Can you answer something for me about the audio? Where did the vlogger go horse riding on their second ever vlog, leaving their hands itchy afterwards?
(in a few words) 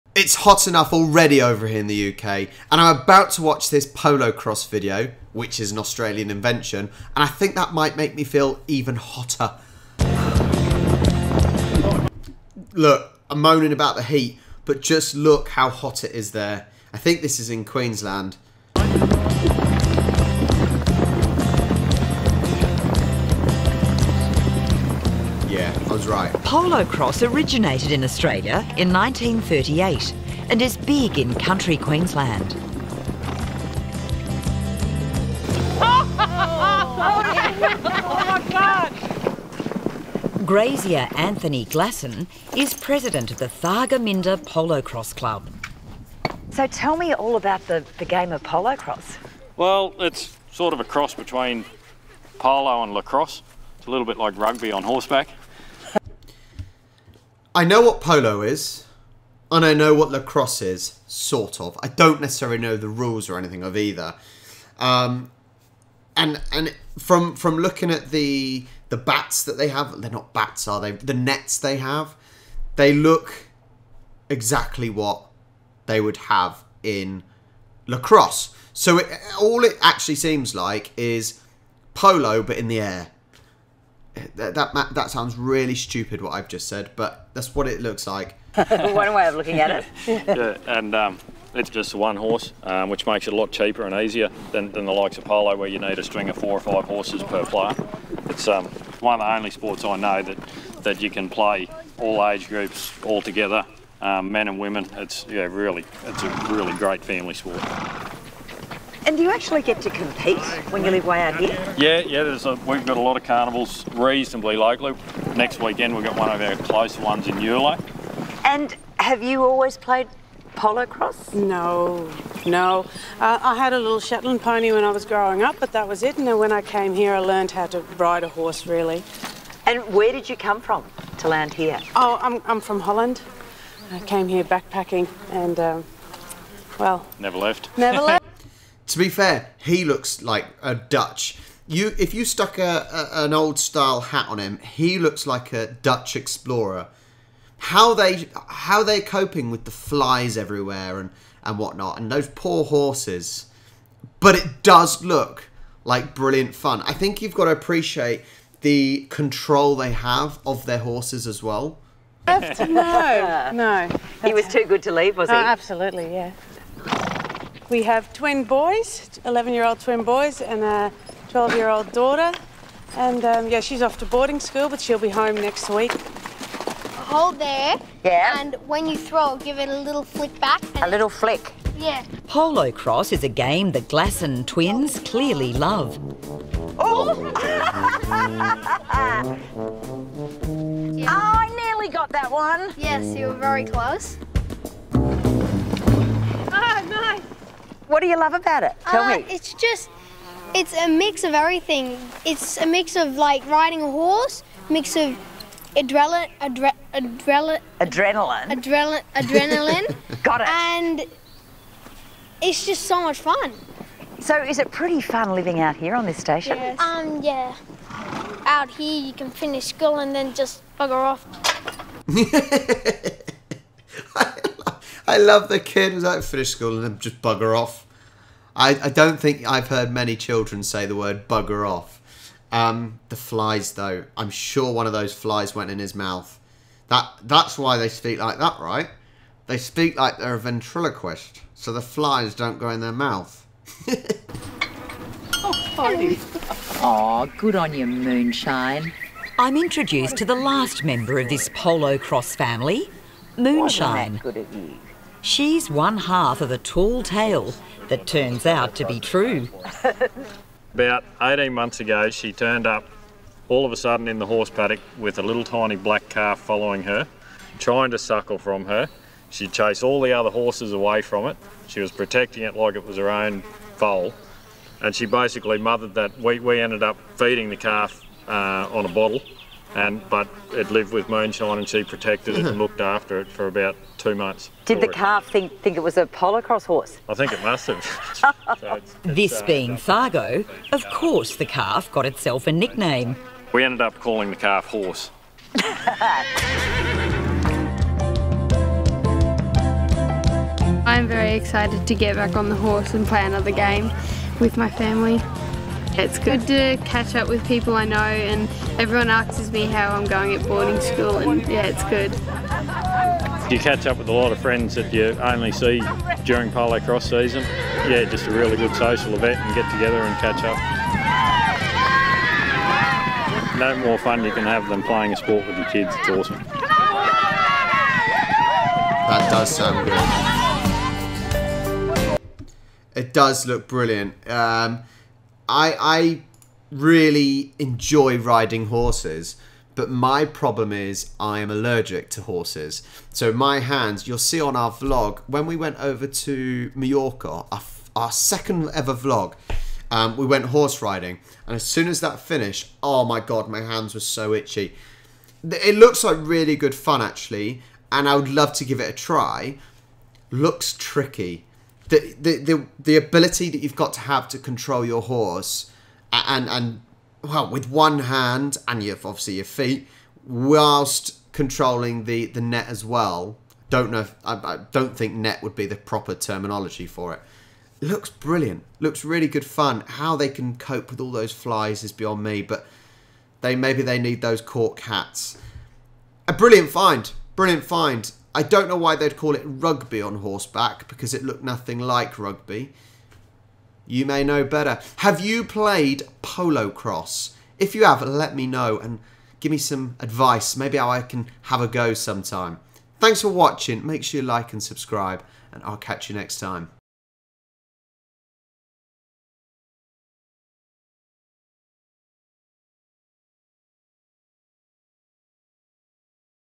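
Mallorca.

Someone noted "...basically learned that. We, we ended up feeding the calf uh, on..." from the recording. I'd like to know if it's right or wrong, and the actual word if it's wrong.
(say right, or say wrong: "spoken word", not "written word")
wrong: "mothered", not "learned".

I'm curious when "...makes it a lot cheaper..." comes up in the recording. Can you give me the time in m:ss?
1:33.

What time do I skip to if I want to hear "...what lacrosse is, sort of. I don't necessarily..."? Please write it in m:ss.
0:59.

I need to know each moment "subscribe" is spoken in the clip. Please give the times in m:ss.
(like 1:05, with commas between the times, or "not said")
6:44.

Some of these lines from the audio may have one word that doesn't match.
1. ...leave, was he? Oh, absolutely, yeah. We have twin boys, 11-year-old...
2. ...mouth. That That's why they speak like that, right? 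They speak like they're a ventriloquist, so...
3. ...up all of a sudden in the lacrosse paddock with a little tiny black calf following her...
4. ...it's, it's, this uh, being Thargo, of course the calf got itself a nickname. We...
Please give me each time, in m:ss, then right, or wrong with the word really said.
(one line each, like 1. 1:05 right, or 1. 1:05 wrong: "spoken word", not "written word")
1. 2:44 right
2. 3:55 right
3. 4:22 wrong: "horse", not "lacrosse"
4. 4:48 right.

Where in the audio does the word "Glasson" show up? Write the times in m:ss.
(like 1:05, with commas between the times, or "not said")
0:41, 3:03.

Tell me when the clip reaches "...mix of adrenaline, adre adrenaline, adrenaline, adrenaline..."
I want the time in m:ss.
3:24.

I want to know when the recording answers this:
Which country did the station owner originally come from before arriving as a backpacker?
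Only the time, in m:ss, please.
2:12.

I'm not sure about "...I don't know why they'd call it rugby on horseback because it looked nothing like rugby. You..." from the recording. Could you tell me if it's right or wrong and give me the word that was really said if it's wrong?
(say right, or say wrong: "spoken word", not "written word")
right.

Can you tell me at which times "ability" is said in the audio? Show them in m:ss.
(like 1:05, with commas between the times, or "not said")
6:02.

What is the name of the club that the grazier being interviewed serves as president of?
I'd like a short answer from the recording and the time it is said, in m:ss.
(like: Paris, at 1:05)
Thargomindah Polo Cross Club, at 0:43.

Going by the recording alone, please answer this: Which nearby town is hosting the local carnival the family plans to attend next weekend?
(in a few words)
Eulo.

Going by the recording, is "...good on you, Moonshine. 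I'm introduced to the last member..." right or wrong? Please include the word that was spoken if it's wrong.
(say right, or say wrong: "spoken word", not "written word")
right.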